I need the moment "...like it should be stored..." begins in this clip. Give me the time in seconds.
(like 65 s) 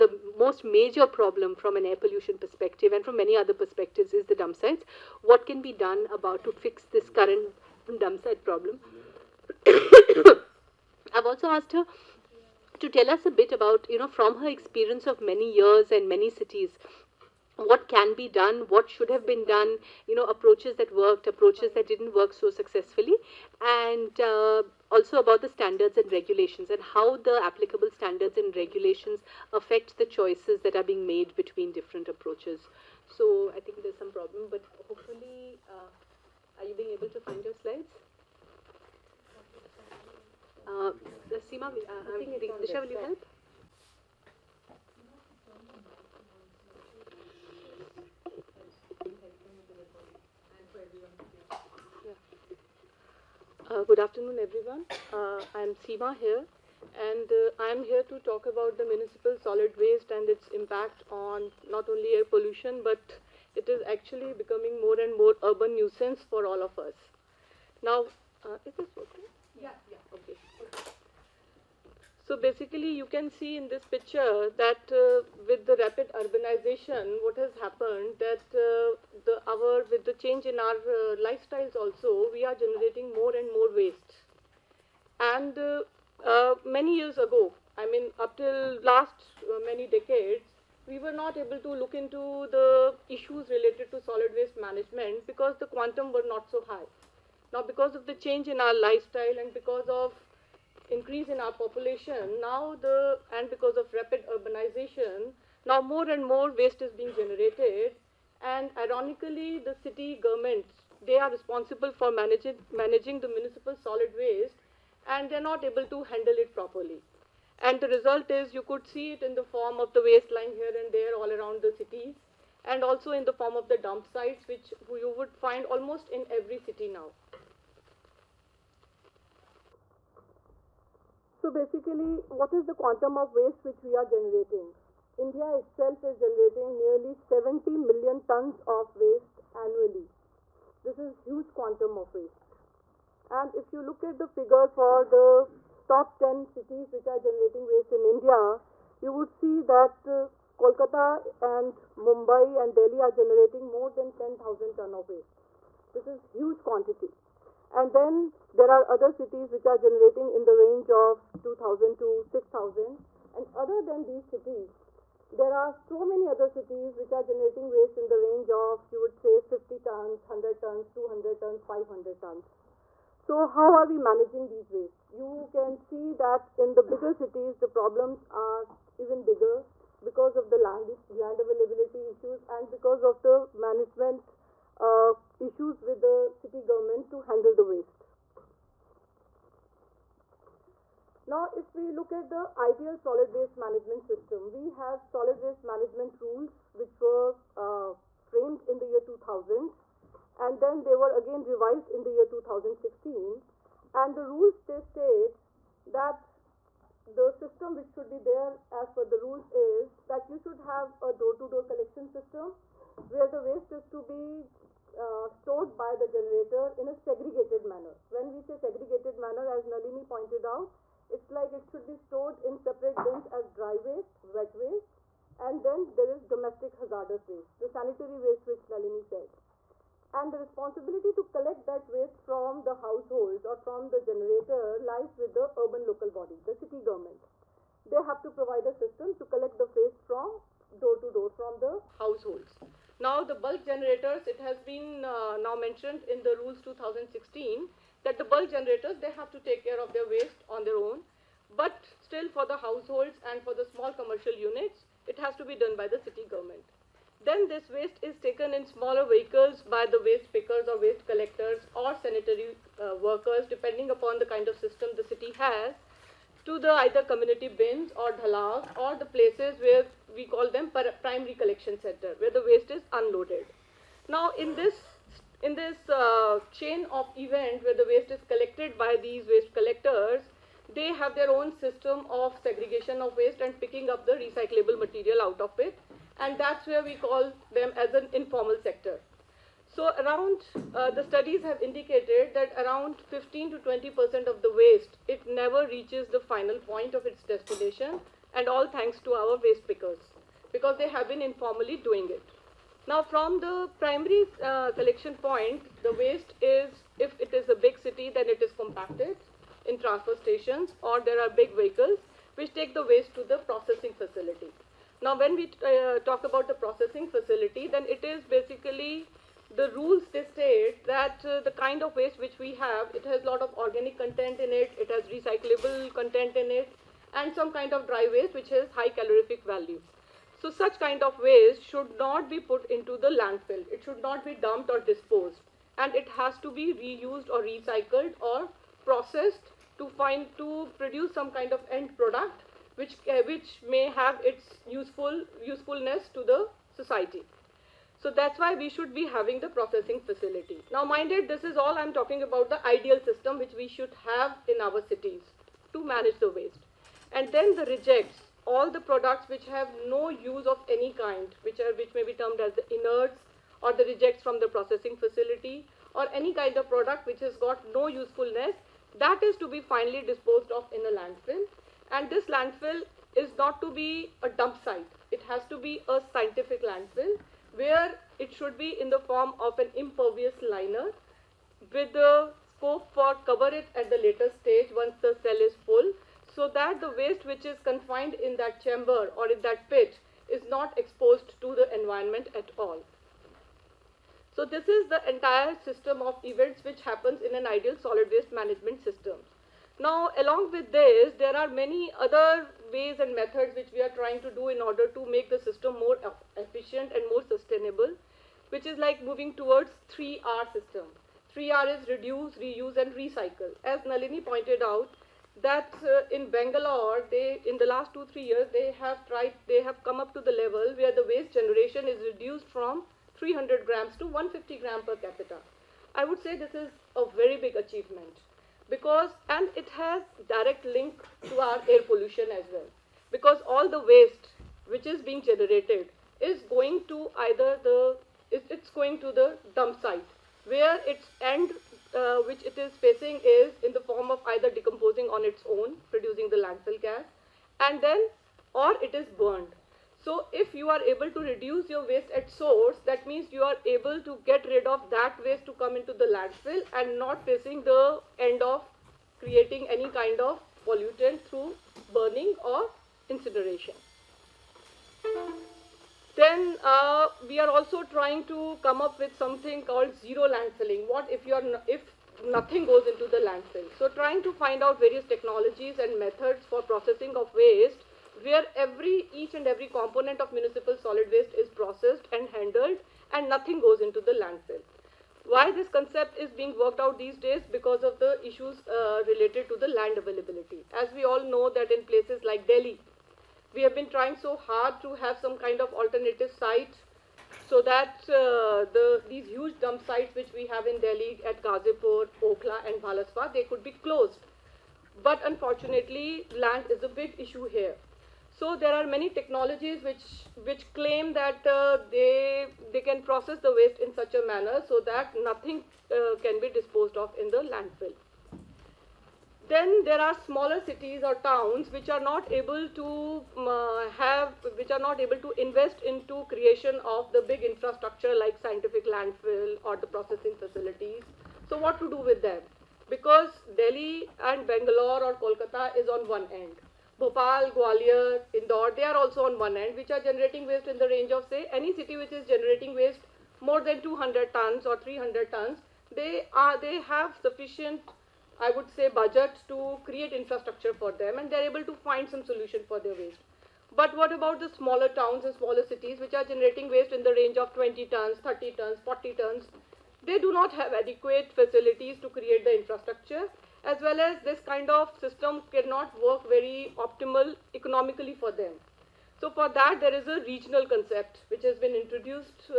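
221 s.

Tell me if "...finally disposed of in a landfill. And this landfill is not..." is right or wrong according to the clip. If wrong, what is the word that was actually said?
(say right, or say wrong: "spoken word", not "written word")
right.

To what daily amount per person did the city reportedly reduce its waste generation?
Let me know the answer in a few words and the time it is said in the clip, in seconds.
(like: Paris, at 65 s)
150 grams, at 424 s.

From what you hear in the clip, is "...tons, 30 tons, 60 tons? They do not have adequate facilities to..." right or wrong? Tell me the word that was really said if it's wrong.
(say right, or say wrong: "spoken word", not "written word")
wrong: "40", not "60".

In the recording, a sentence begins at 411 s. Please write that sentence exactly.
3R is reduce, reuse and recycle.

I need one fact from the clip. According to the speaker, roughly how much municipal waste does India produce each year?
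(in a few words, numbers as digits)
70 million tons.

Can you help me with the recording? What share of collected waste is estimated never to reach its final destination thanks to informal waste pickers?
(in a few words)
15 to 20%.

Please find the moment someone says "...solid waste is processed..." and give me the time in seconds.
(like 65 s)
480 s.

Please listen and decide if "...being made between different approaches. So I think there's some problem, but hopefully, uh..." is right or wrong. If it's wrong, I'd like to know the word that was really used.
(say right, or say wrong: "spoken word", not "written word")
right.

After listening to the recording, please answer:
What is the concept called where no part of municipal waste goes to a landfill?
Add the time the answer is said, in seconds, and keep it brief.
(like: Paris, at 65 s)
zero landfilling, at 469 s.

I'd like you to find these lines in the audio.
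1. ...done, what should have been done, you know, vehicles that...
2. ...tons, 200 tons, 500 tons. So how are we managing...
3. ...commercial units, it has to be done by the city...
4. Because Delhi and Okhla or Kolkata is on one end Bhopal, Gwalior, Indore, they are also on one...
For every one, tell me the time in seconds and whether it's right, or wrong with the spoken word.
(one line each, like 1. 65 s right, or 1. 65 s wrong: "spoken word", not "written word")
1. 18 s wrong: "approaches", not "vehicles"
2. 170 s right
3. 253 s right
4. 532 s wrong: "Bangalore", not "Okhla".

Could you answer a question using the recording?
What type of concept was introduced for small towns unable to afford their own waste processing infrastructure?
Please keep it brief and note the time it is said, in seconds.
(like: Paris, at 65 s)
regional concept, at 570 s.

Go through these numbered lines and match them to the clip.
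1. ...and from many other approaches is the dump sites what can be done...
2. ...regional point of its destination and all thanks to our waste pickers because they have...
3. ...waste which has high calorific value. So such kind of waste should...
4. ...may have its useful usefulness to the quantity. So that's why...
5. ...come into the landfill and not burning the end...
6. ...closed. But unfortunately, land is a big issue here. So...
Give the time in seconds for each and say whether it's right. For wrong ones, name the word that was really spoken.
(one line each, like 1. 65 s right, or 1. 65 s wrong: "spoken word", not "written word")
1. 2 s wrong: "perspectives", not "approaches"
2. 296 s wrong: "final", not "regional"
3. 328 s right
4. 343 s wrong: "society", not "quantity"
5. 455 s wrong: "facing", not "burning"
6. 503 s right.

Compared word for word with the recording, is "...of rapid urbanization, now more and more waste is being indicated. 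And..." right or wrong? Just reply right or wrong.
wrong.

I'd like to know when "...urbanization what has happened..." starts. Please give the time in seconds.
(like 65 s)
76 s.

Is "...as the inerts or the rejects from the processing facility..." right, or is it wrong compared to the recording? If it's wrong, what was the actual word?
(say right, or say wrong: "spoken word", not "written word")
right.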